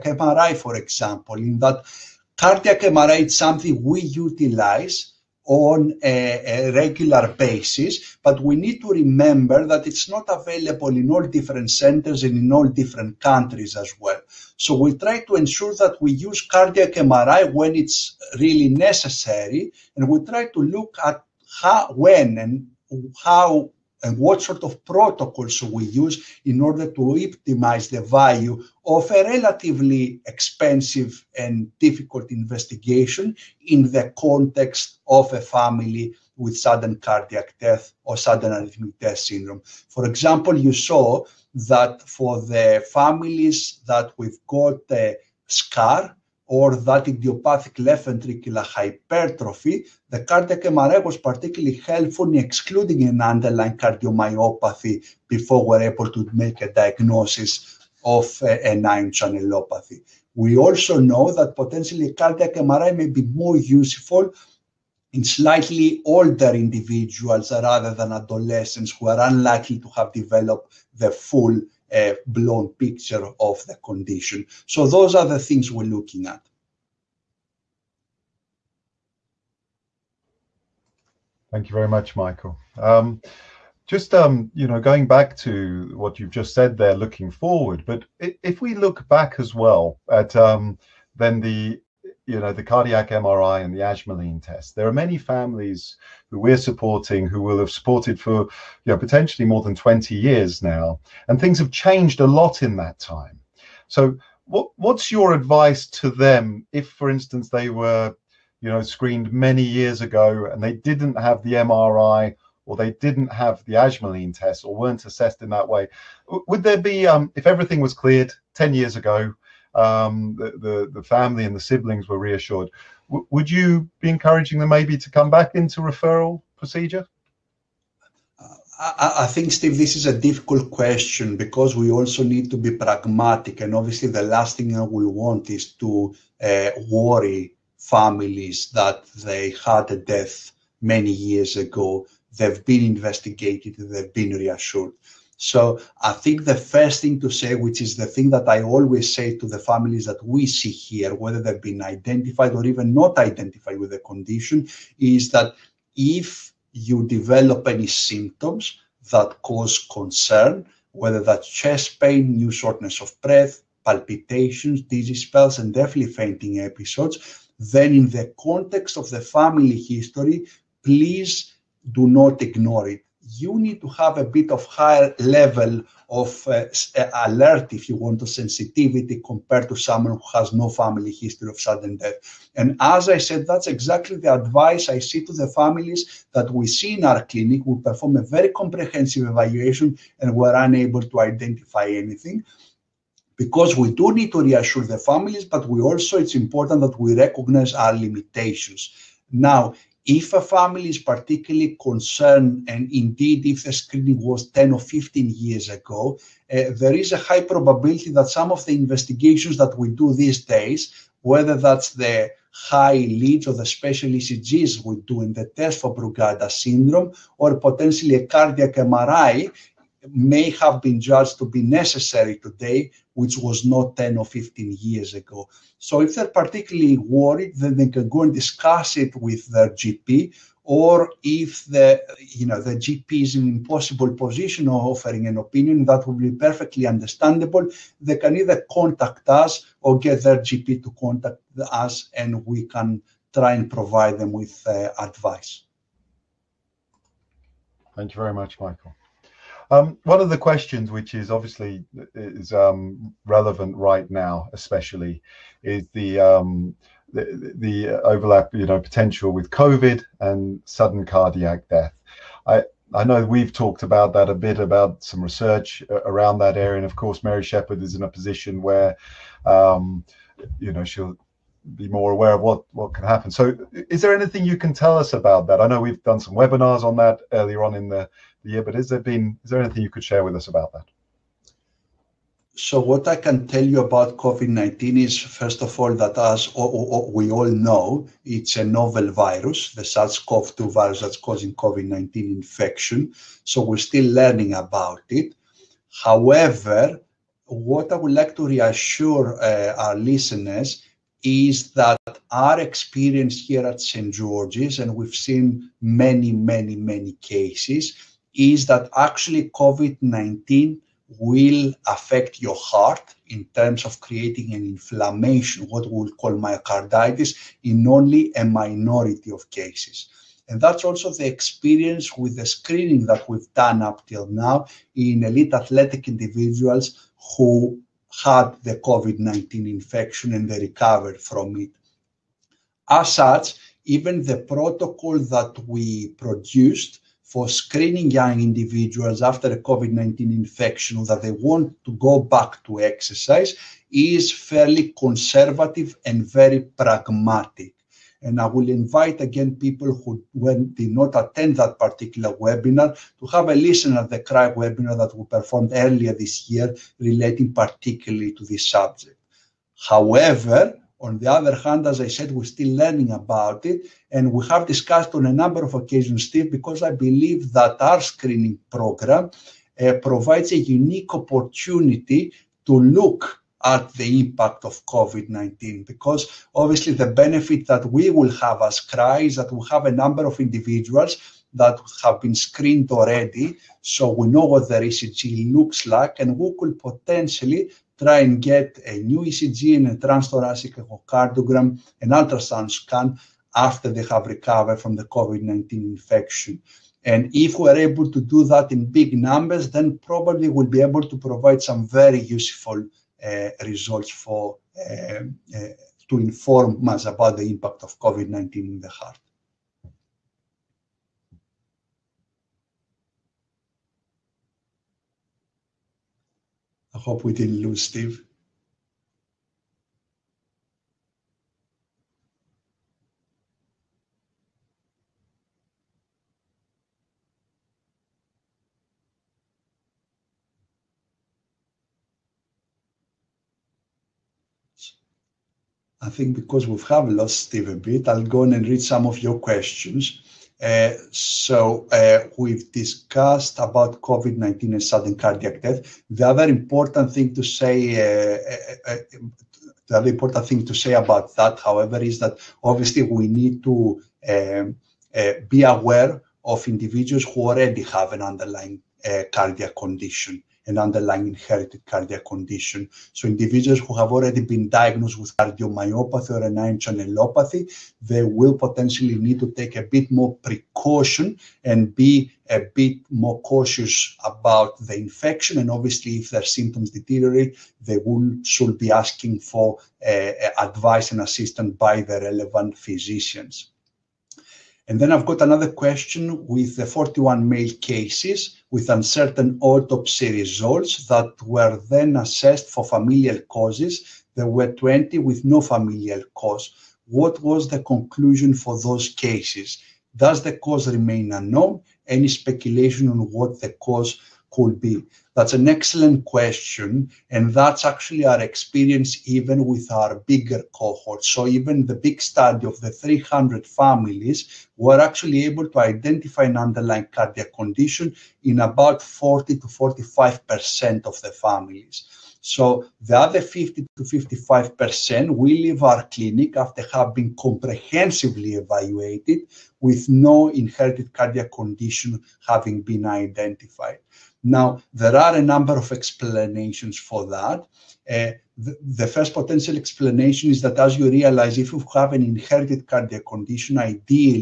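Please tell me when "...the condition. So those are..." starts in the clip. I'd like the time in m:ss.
1:13.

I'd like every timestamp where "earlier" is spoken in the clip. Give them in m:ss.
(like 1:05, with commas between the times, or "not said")
4:37, 5:55.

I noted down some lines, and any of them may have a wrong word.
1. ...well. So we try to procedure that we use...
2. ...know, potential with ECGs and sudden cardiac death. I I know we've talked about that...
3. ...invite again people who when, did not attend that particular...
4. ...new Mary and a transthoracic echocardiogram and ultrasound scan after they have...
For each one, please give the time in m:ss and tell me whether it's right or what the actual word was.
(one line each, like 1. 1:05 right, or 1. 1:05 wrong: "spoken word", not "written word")
1. 0:13 wrong: "ensure", not "procedure"
2. 4:18 wrong: "COVID", not "ECGs"
3. 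5:48 right
4. 6:28 wrong: "ECG", not "Mary".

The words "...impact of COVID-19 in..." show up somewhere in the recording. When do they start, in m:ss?
6:47.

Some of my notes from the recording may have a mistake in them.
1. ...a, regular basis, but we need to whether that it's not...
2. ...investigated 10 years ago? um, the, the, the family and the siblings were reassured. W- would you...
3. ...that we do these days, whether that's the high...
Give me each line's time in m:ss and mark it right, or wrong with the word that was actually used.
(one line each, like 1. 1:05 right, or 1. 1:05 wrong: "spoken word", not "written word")
1. 0:06 wrong: "remember", not "whether"
2. 1:57 wrong: "cleared", not "investigated"
3. 3:29 right.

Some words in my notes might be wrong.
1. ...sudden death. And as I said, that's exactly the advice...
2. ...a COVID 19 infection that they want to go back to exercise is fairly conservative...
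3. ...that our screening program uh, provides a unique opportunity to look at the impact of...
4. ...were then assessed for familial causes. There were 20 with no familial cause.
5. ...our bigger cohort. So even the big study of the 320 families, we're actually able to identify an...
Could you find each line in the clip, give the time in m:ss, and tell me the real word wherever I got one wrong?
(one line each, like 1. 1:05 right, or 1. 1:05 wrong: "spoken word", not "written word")
1. 3:01 right
2. 5:39 right
3. 6:07 right
4. 8:11 right
5. 8:29 wrong: "300", not "320".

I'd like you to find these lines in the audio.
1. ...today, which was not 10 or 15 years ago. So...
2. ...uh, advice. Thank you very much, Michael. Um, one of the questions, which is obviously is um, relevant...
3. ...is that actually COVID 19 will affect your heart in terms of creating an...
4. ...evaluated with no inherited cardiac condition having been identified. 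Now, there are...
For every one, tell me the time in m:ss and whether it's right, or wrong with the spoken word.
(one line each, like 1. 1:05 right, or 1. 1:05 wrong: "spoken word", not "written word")
1. 3:42 right
2. 4:04 right
3. 5:08 right
4. 8:48 right.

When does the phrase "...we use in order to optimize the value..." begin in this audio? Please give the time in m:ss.
0:25.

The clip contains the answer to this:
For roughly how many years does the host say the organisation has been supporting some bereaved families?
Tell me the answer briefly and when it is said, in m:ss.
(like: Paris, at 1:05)
20 years, at 1:39.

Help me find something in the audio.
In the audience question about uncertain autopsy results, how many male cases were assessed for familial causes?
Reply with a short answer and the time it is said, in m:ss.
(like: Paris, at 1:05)
41, at 8:06.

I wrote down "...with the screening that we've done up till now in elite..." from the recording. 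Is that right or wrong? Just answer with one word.
right.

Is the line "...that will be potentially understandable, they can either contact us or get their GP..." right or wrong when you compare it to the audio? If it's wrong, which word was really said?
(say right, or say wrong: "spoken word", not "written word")
wrong: "perfectly", not "potentially".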